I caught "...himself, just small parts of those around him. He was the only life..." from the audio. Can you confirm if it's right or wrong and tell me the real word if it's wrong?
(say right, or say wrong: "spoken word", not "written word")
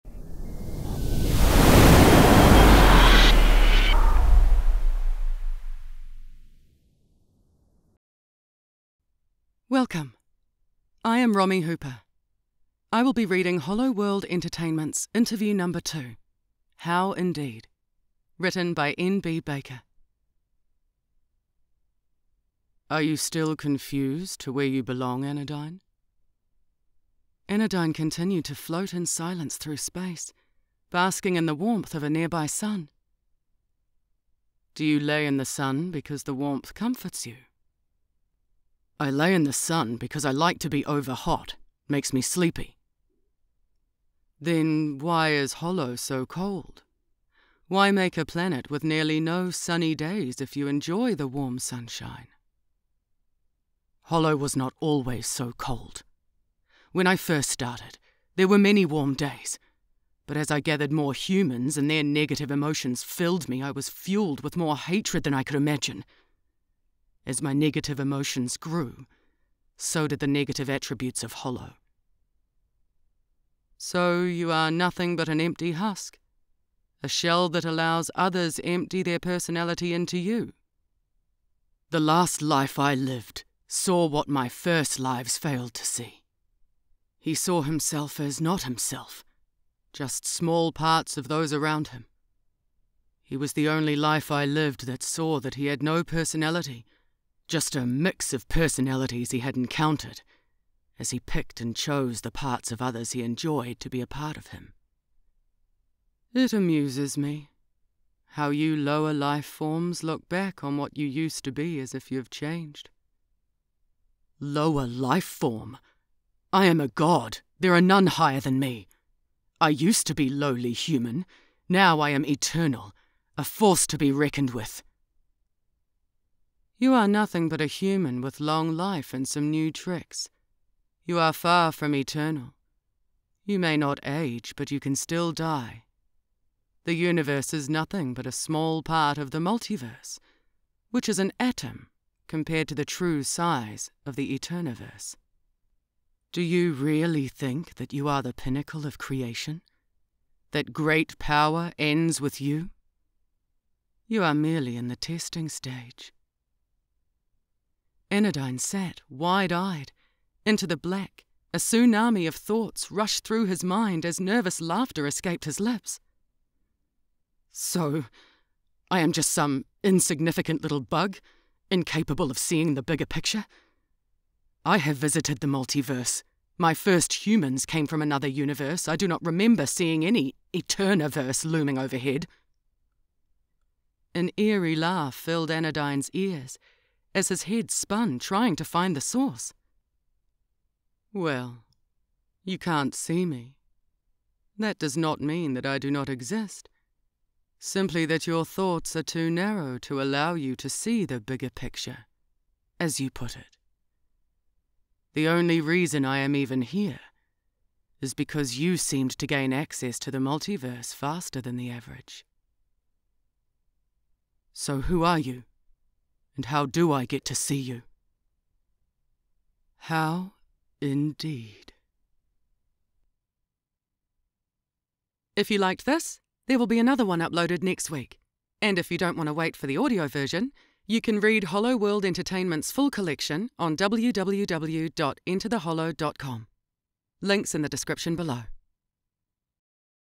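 right.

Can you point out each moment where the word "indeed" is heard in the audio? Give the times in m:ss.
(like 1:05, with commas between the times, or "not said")
0:17, 3:40.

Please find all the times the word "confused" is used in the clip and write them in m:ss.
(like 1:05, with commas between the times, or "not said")
0:23.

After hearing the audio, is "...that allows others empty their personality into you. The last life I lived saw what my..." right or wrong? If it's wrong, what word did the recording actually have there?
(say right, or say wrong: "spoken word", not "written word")
right.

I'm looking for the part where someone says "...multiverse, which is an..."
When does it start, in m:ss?
2:19.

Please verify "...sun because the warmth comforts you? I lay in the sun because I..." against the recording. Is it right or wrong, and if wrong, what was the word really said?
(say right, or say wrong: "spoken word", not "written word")
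right.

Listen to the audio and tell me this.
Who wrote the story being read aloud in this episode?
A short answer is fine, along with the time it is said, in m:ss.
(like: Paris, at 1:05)
N.B. Baker, at 0:18.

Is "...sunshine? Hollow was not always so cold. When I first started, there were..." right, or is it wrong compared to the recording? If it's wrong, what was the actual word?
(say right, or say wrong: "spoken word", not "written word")
right.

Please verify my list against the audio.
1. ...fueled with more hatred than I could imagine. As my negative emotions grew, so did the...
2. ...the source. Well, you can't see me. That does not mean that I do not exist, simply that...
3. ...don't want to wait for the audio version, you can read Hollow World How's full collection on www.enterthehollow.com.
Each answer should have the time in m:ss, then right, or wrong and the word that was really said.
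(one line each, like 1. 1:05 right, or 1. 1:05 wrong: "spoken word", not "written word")
1. 1:03 right
2. 3:08 right
3. 3:48 wrong: "Entertainment", not "How".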